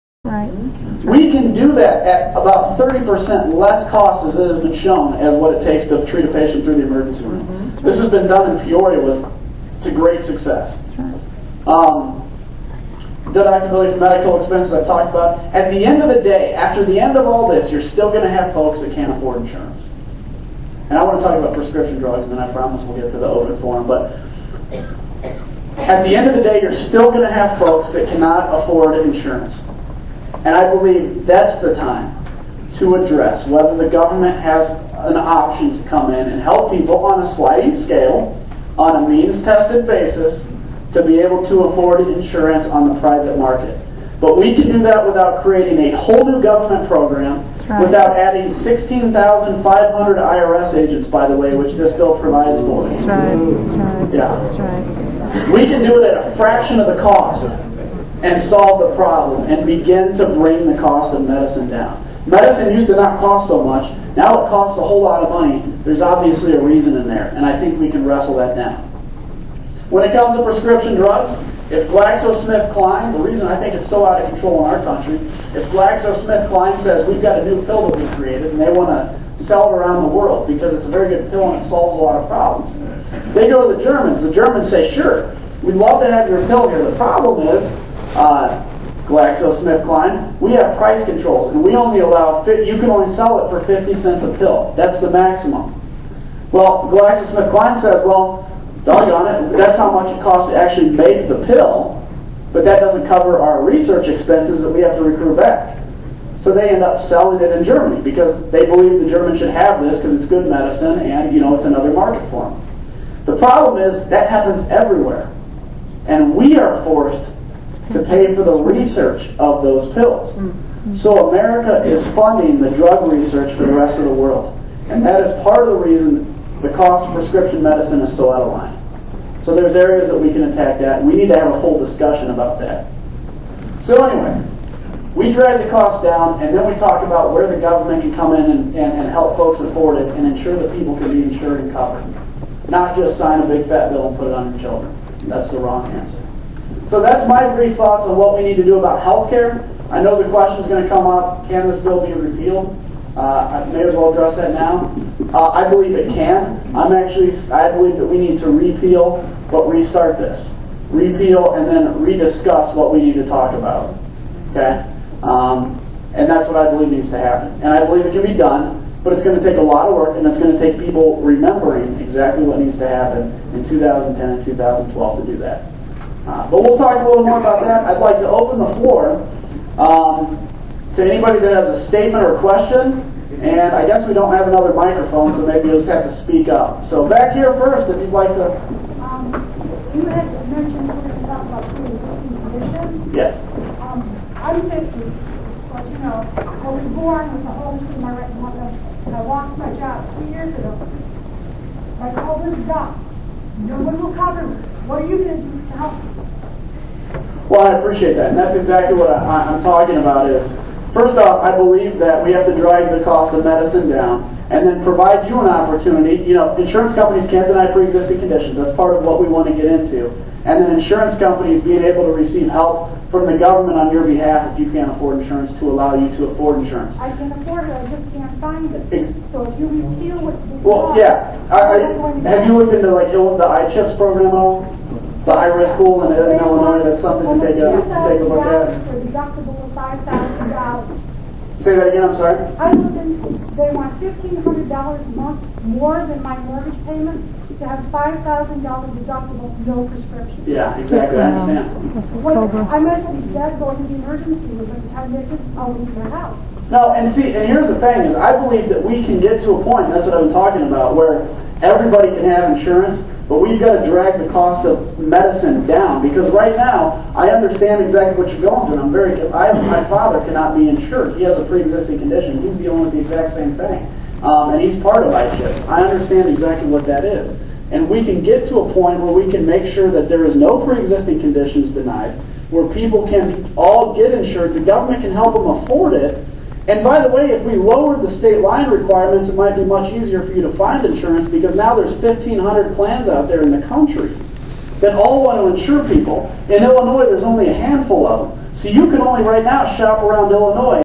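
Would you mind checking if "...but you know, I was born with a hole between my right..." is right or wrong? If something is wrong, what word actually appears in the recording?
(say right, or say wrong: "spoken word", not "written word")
right.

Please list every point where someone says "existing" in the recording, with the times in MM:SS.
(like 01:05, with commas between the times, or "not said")
03:11, 03:37, 04:31, 04:40.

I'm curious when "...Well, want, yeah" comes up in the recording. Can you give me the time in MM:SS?
03:50.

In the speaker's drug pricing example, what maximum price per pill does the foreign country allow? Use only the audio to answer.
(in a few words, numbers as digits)
50 cents.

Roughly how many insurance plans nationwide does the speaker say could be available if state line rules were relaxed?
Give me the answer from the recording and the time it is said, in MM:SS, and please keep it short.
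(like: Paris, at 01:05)
1,500, at 04:51.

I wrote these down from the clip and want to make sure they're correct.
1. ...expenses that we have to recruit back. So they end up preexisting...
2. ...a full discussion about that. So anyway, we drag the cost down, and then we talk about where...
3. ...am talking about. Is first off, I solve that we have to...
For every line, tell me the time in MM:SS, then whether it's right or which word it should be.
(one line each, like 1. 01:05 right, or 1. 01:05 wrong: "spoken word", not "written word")
1. 01:44 wrong: "selling", not "preexisting"
2. 02:11 right
3. 03:29 wrong: "believe", not "solve".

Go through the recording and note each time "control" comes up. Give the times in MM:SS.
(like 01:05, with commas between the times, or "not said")
01:14, 01:31.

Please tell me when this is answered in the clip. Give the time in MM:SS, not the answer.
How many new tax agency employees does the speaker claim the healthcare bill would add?
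00:48.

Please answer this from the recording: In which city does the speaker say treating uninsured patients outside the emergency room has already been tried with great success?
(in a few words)
Peoria.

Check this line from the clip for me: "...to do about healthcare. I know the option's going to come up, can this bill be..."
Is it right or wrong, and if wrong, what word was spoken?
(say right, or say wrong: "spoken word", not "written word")
wrong: "question", not "option".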